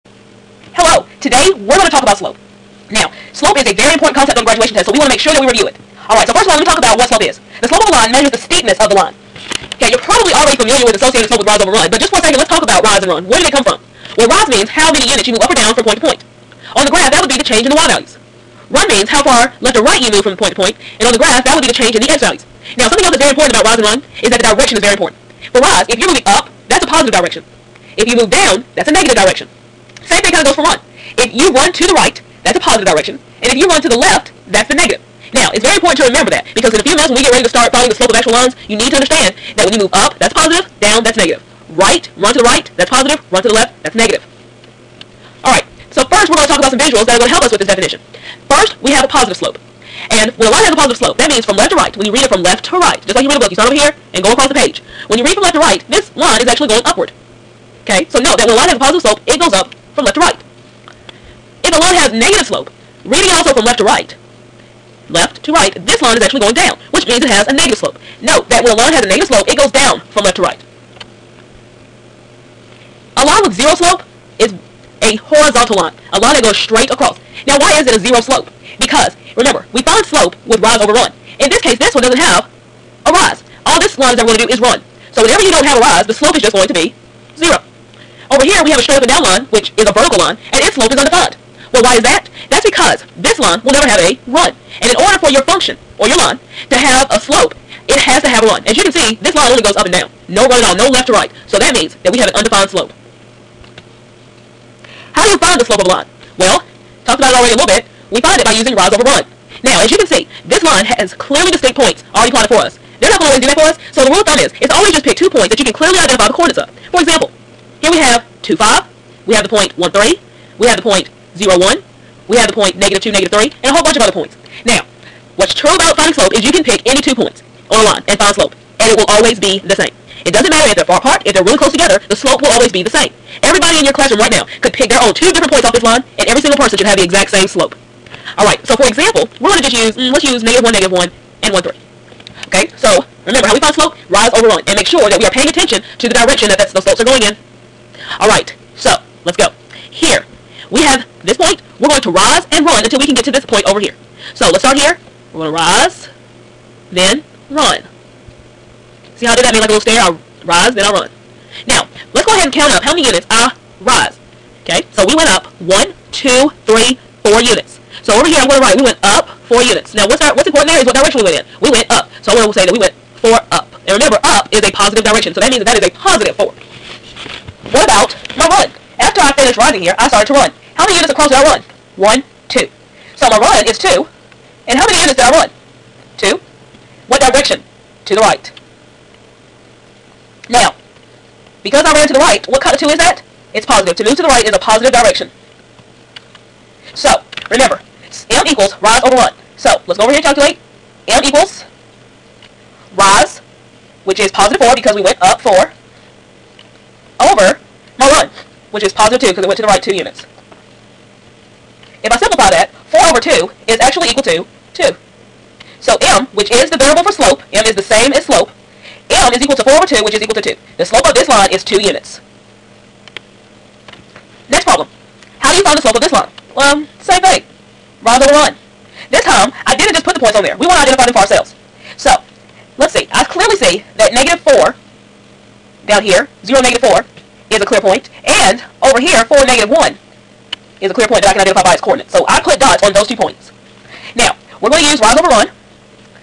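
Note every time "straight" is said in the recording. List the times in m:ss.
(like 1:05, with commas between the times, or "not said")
1:16, 1:28.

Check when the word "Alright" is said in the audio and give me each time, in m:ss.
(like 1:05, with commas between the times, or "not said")
0:06, 0:45, 2:18, 2:28.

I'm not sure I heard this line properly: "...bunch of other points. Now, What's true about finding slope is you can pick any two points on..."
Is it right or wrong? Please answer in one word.
right.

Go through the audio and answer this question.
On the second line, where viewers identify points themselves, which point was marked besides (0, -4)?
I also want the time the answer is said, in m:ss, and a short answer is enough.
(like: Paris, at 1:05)
(4, -1), at 3:59.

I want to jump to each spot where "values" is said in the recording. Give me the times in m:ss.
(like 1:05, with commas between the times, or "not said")
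0:17, 0:22.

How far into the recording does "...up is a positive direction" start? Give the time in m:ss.
2:54.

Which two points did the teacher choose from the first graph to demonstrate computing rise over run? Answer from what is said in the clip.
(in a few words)
(-1, -1) and (1, 3).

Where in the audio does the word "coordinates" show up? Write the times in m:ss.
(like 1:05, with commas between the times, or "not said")
1:56, 4:01.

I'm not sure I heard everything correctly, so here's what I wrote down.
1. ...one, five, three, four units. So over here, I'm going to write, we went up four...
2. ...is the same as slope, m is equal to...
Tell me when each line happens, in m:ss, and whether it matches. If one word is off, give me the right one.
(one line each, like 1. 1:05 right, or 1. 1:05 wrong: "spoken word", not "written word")
1. 2:45 wrong: "two", not "five"
2. 3:37 right.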